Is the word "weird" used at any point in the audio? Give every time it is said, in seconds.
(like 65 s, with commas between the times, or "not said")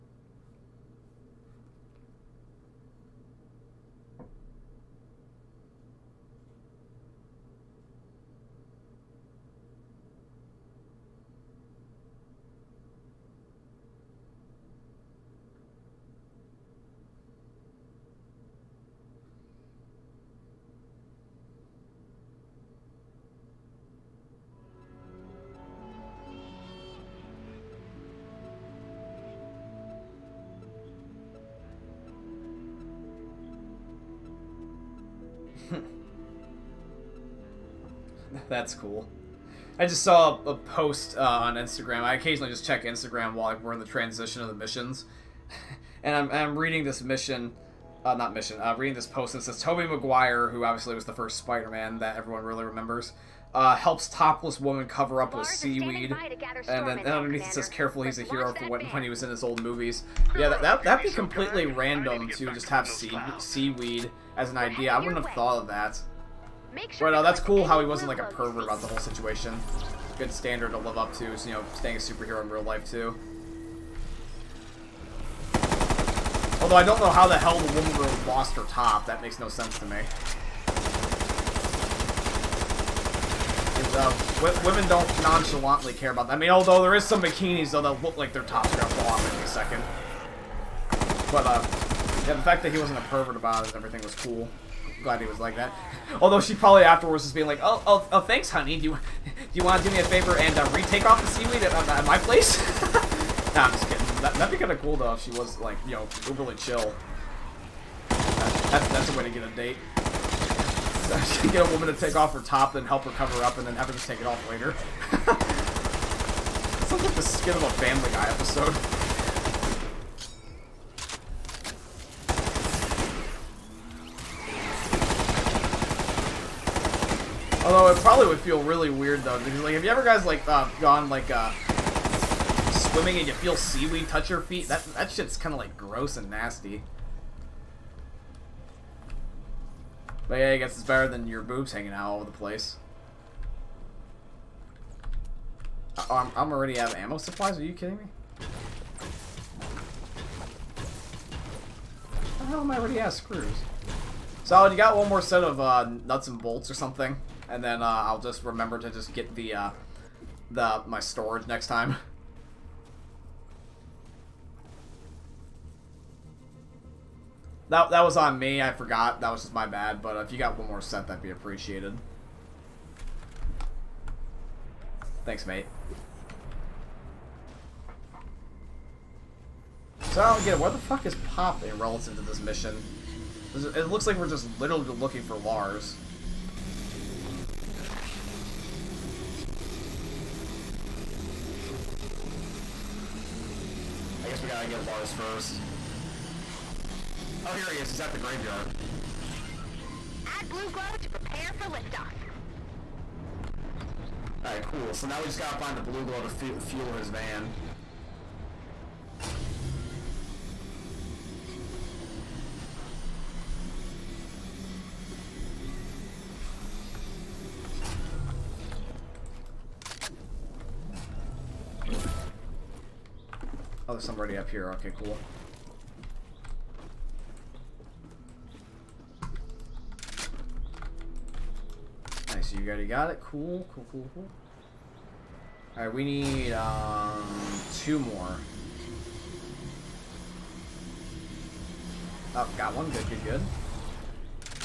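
128 s.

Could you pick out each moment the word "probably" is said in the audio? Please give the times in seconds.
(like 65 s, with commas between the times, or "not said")
96 s, 127 s.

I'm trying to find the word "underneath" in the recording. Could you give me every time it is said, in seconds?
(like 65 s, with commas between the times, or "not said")
57 s.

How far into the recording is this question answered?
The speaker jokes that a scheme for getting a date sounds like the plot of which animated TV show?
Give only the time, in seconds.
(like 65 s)
117 s.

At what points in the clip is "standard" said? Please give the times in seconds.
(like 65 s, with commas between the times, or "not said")
70 s.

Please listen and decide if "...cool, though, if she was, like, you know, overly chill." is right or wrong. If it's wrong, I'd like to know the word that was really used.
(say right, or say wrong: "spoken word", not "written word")
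right.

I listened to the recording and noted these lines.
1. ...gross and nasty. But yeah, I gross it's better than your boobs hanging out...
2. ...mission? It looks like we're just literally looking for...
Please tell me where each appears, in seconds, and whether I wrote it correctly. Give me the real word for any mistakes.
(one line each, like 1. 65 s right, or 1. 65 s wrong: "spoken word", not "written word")
1. 135 s wrong: "guess", not "gross"
2. 182 s right.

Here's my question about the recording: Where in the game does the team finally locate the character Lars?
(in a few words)
the graveyard.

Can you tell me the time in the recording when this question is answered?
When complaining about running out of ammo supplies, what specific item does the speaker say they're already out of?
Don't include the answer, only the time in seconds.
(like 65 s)
153 s.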